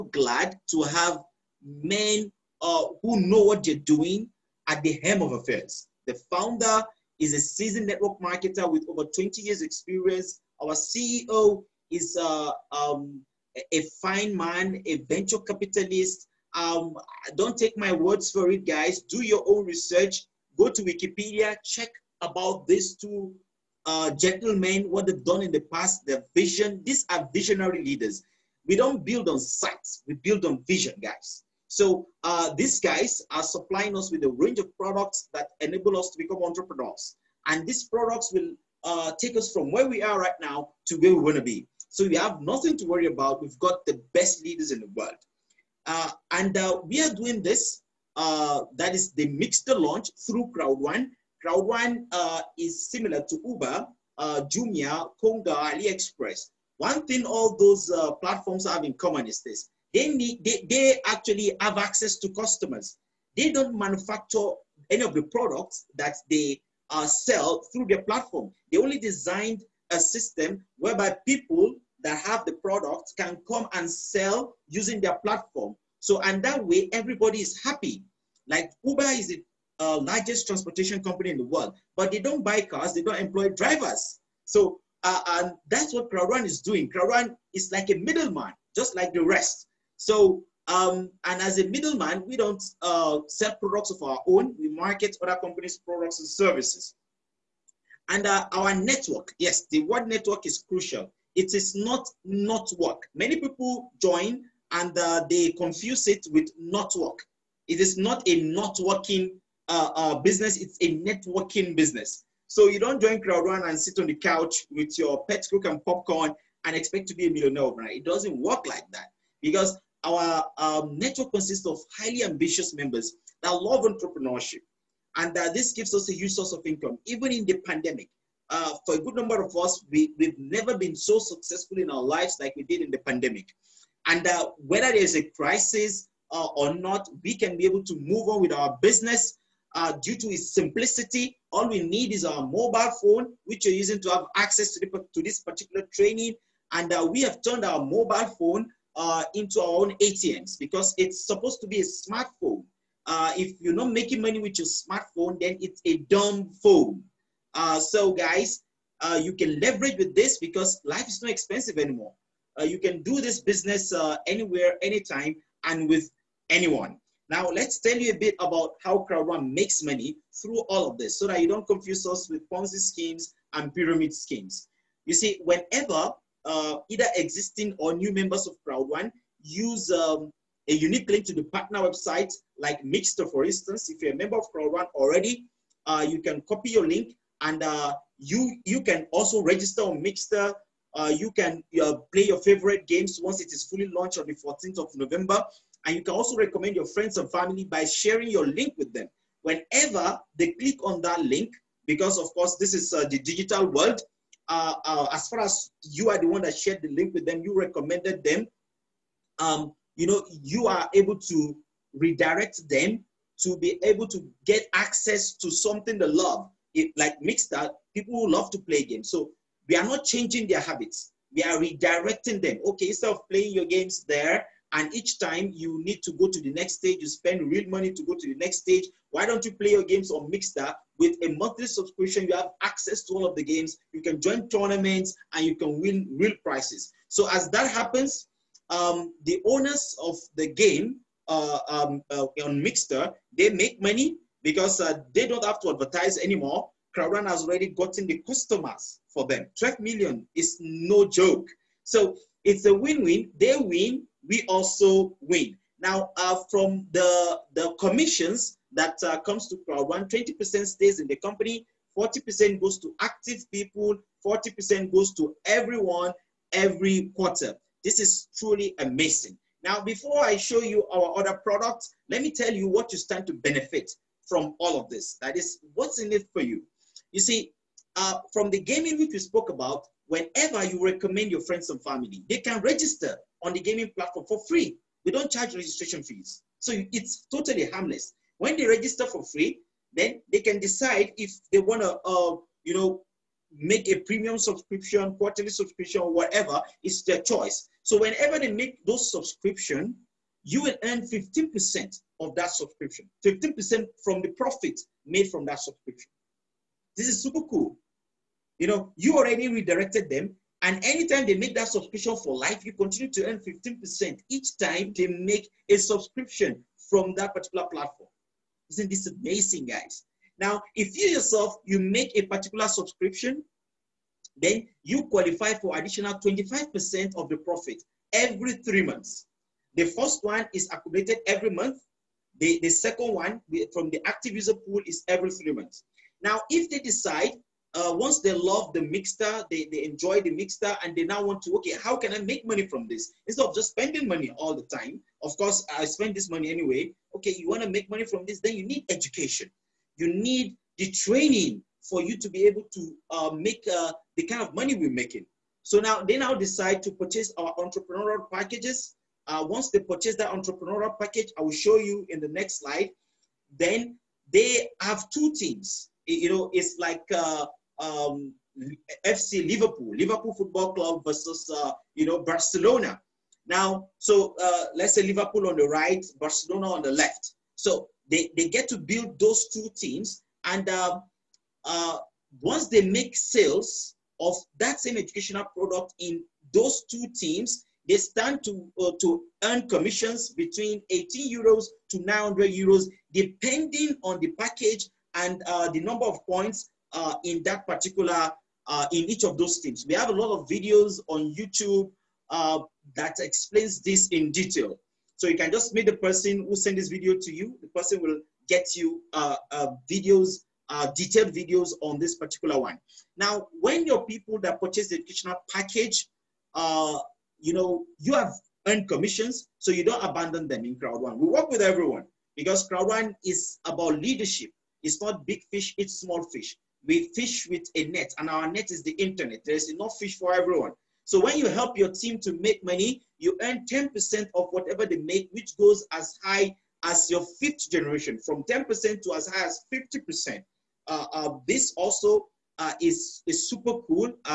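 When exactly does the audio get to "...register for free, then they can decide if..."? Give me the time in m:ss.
4:48.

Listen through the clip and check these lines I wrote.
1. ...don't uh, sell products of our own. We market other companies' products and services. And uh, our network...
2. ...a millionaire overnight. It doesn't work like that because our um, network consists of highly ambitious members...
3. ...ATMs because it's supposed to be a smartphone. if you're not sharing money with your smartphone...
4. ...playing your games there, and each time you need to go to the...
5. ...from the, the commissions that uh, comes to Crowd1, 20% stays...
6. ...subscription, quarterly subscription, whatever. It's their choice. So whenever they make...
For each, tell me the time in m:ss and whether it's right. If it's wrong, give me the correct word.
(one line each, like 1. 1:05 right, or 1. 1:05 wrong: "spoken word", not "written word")
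1. 1:32 right
2. 1:57 right
3. 2:30 wrong: "making", not "sharing"
4. 3:43 right
5. 4:16 right
6. 4:54 right.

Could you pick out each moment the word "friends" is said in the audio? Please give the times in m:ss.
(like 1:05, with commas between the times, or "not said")
3:16, 4:41.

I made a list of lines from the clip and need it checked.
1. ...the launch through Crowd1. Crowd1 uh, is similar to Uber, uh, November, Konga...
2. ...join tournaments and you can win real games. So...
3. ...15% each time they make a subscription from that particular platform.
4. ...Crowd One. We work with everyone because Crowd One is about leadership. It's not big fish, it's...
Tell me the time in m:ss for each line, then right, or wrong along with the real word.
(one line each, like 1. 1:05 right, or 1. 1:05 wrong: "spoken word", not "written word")
1. 0:49 wrong: "Jumia", not "November"
2. 3:54 wrong: "prizes", not "games"
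3. 5:13 right
4. 7:00 right.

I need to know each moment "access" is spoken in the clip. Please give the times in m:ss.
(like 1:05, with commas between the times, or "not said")
1:01, 2:24, 3:34, 3:52.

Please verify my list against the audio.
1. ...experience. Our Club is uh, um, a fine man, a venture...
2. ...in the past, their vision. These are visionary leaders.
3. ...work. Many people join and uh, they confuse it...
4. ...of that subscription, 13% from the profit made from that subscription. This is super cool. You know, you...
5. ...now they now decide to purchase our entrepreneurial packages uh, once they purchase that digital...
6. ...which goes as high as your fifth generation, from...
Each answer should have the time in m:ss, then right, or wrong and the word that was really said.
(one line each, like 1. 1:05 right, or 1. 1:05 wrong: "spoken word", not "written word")
1. 0:09 wrong: "CEO", not "Club"
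2. 0:25 right
3. 1:42 right
4. 5:02 wrong: "15", not "13"
5. 5:55 wrong: "entrepreneurial", not "digital"
6. 7:15 right.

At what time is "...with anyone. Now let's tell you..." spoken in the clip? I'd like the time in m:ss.
2:45.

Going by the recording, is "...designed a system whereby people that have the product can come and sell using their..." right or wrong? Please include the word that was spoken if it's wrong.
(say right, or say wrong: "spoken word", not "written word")
right.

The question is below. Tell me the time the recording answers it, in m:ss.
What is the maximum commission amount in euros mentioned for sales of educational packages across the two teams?
6:32.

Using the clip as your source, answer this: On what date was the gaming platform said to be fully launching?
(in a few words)
14th of November.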